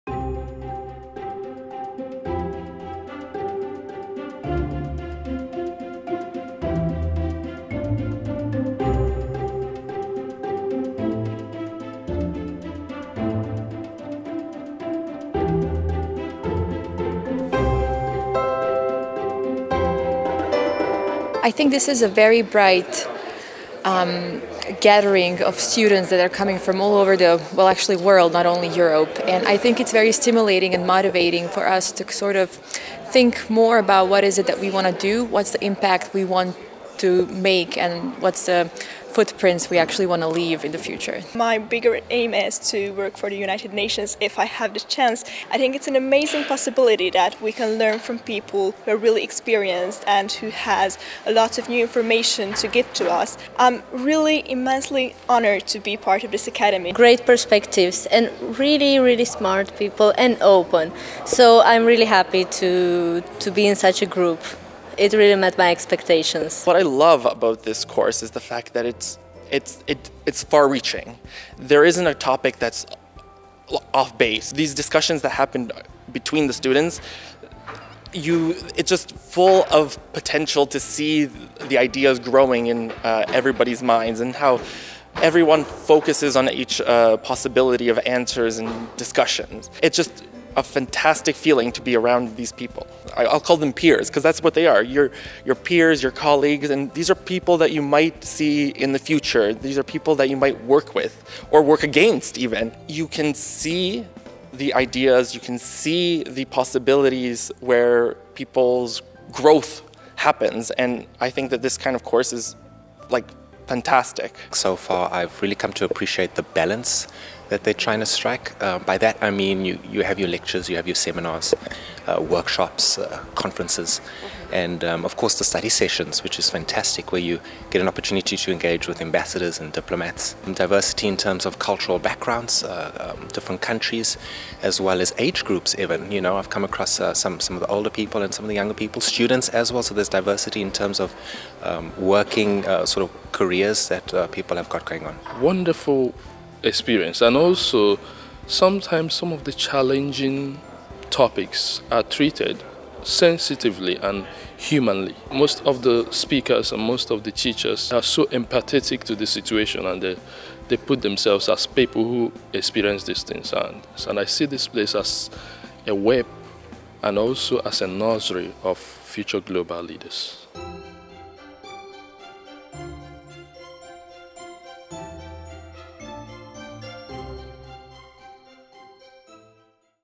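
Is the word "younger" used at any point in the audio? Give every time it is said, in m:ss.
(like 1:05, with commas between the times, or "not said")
2:18.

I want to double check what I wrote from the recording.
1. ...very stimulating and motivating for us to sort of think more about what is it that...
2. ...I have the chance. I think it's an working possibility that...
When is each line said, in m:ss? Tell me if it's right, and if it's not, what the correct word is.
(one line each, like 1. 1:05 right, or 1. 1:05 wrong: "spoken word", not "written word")
1. 0:29 right
2. 0:44 wrong: "amazing", not "working".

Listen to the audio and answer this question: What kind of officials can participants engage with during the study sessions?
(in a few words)
Ambassadors.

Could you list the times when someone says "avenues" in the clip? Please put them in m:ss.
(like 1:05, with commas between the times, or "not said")
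not said.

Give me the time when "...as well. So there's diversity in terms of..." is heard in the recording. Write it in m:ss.
2:19.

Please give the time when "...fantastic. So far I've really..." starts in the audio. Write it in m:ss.
1:53.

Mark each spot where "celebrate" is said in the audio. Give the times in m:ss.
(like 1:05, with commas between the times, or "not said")
not said.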